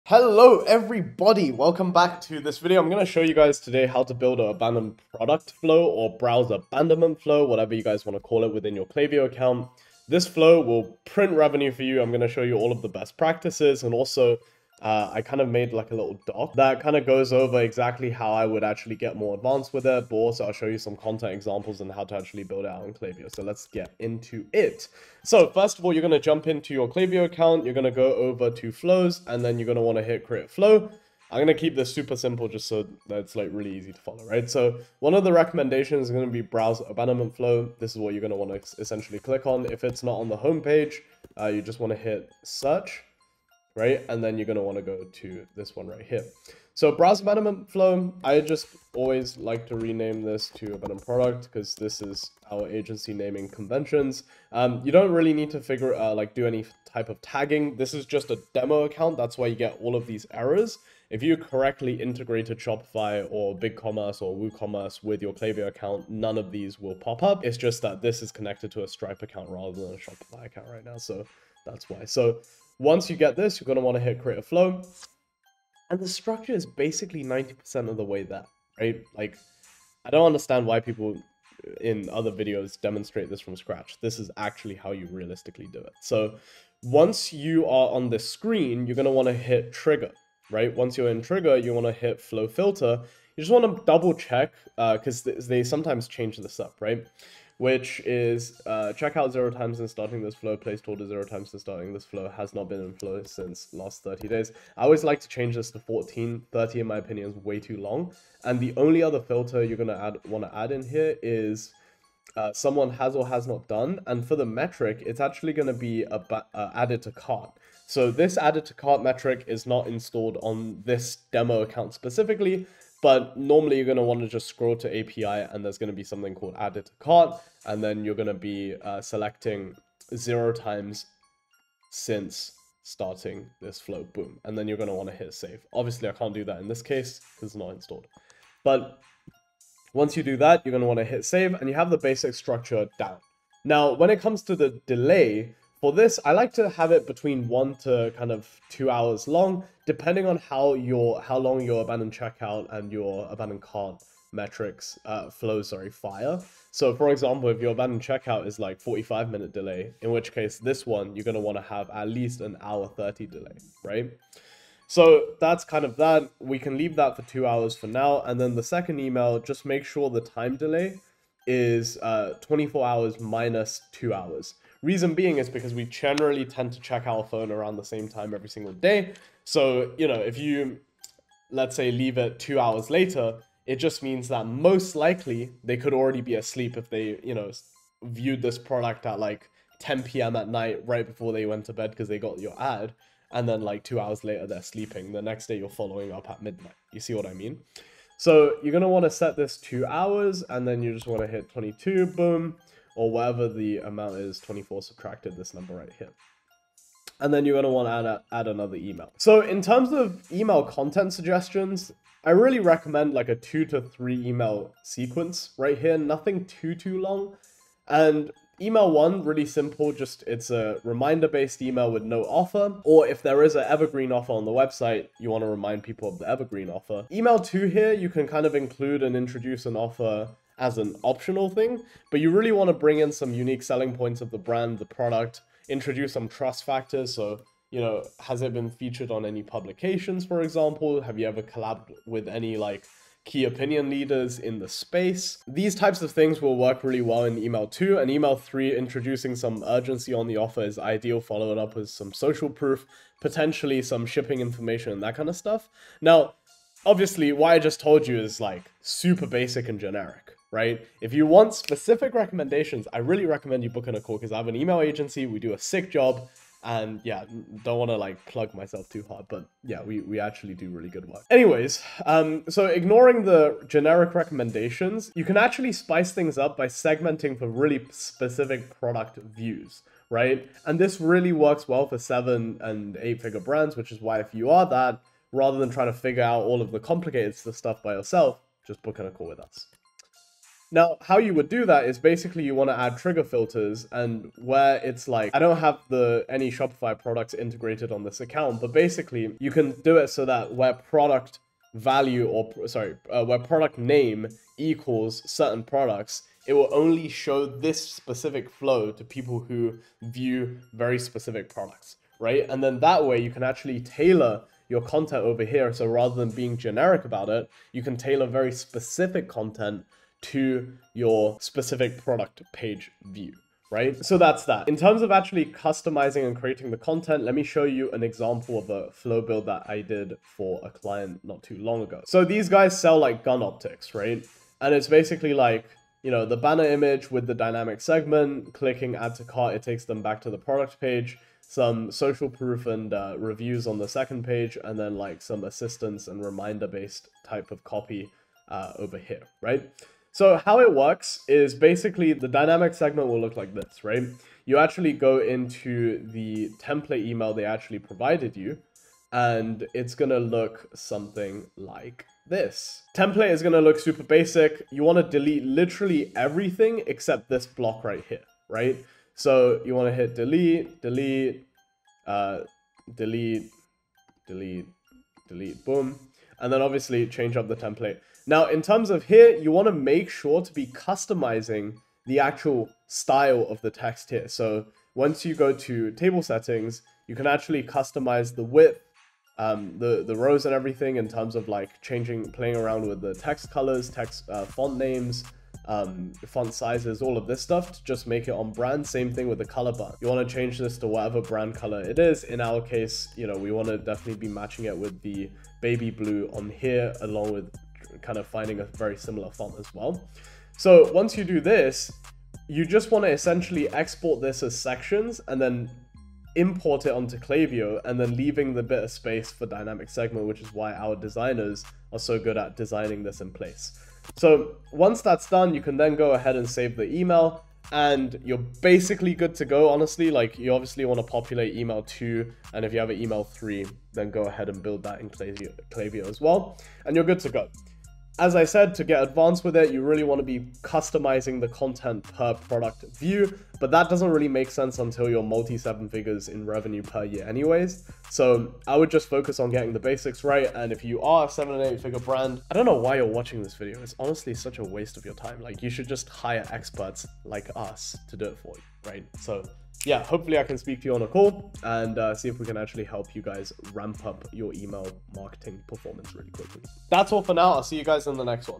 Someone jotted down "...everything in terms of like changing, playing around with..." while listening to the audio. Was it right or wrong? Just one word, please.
right.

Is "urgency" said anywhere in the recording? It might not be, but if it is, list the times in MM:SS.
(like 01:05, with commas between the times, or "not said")
04:09.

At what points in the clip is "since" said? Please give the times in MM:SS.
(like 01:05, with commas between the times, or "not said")
01:43, 02:11.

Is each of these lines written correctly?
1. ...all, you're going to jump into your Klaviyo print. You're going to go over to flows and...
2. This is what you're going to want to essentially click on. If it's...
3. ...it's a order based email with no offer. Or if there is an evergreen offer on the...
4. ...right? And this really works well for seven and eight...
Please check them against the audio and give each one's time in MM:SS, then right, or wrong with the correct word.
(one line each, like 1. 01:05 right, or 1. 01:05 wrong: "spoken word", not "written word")
1. 00:25 wrong: "account", not "print"
2. 00:37 right
3. 03:40 wrong: "reminder", not "order"
4. 04:40 right.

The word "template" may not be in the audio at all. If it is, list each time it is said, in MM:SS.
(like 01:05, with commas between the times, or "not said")
05:56, 06:02, 06:17.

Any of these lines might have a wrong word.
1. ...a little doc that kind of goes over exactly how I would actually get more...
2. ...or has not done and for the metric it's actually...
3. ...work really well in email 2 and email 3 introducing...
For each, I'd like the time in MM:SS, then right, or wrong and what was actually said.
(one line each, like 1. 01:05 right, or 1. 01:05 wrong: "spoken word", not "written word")
1. 00:15 right
2. 01:53 right
3. 04:06 right.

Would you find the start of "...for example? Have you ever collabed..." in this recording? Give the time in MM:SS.
04:00.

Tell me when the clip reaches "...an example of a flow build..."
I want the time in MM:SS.
05:27.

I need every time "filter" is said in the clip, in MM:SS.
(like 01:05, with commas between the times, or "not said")
01:32, 01:49, 04:53.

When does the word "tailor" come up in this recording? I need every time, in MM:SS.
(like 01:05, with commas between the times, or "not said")
05:13, 05:17.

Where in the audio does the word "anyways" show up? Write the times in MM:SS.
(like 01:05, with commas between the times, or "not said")
04:31, 07:27.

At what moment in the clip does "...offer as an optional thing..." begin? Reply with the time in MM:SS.
03:49.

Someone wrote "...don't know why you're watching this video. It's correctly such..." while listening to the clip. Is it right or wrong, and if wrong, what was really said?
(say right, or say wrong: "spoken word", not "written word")
wrong: "honestly", not "correctly".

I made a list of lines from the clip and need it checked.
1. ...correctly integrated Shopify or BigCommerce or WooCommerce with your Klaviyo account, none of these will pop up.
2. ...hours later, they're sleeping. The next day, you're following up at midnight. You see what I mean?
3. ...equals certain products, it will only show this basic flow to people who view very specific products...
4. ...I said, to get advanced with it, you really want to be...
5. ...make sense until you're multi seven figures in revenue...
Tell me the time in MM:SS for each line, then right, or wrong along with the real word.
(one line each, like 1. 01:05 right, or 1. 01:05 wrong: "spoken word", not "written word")
1. 01:01 right
2. 03:13 right
3. 05:04 wrong: "specific", not "basic"
4. 07:18 right
5. 07:24 right.